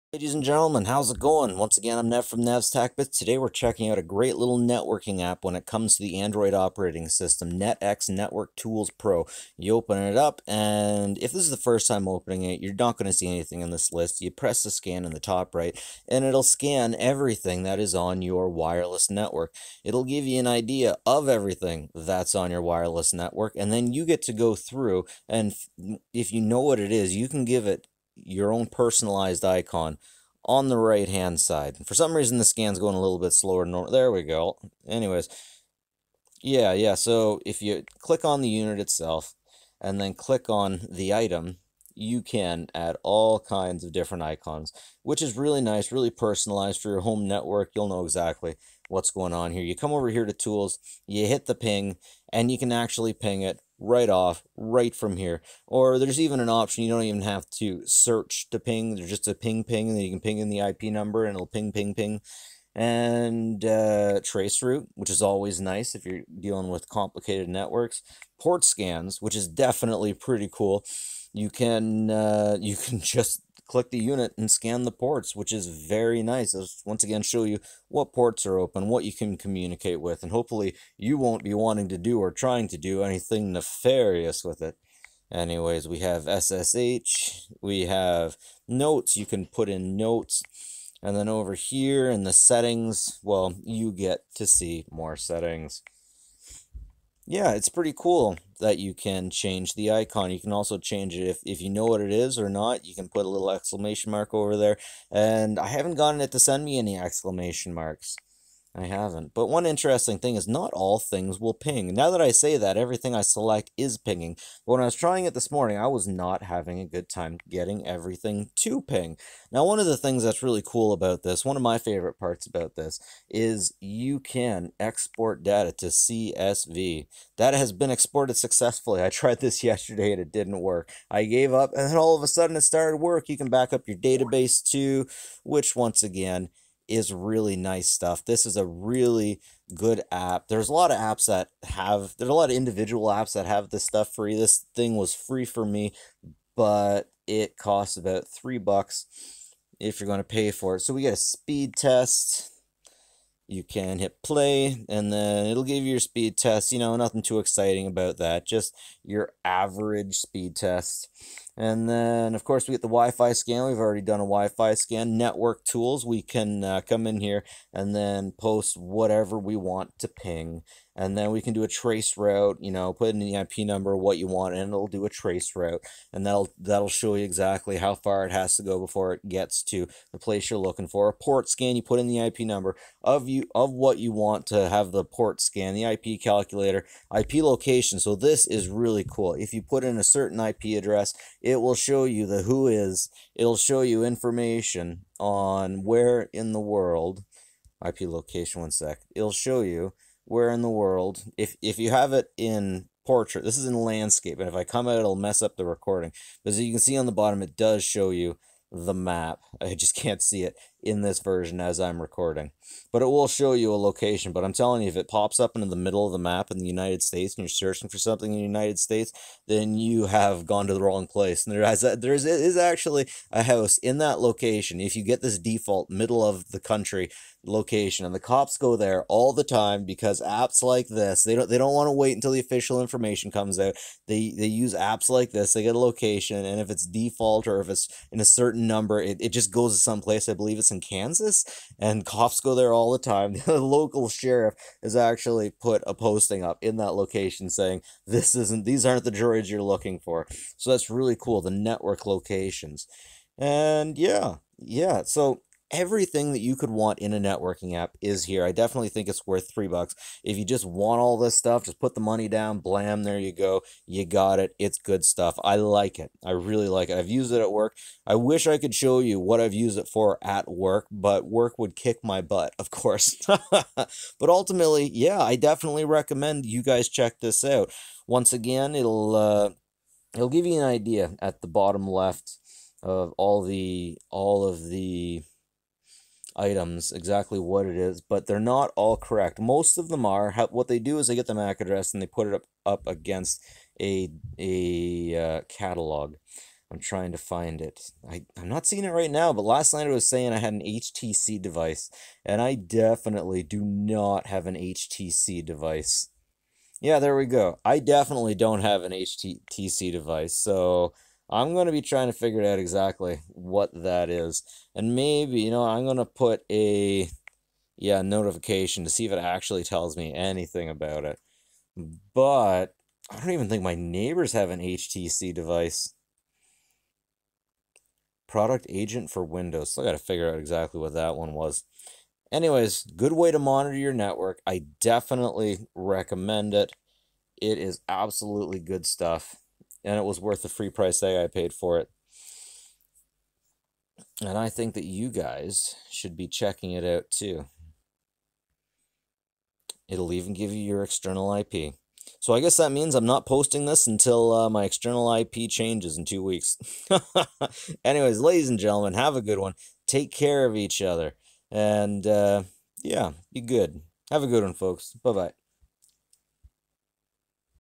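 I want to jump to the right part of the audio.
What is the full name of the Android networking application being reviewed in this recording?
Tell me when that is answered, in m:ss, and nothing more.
0:07.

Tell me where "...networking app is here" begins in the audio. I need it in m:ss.
4:17.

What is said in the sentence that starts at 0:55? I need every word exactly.
Or there's even an option you don't even have to search to ping.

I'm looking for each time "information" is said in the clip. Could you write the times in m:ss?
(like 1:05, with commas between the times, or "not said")
3:14, 3:52.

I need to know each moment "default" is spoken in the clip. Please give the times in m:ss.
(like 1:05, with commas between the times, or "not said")
3:45, 3:56.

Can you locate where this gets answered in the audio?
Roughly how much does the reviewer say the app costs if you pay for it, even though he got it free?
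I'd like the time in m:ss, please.
2:28.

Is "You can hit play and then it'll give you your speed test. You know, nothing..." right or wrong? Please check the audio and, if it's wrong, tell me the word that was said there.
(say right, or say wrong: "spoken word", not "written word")
right.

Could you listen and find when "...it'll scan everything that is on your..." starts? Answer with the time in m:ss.
0:16.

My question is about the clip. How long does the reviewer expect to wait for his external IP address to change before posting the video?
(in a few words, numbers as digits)
2 weeks.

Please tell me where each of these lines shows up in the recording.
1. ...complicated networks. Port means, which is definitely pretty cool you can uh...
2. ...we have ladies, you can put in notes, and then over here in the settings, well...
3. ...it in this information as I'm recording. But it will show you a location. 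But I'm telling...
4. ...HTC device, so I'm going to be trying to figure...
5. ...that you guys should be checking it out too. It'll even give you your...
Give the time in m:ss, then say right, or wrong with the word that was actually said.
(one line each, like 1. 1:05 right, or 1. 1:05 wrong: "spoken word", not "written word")
1. 1:06 wrong: "scans", not "means"
2. 1:27 wrong: "notes", not "ladies"
3. 3:30 wrong: "version", not "information"
4. 5:08 right
5. 5:44 right.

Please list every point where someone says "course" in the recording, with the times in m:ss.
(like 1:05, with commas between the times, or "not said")
2:42, 4:32.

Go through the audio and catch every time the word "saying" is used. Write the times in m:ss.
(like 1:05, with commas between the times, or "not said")
4:07, 5:00.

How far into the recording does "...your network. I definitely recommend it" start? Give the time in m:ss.
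5:33.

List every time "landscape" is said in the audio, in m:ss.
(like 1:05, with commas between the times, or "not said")
3:23.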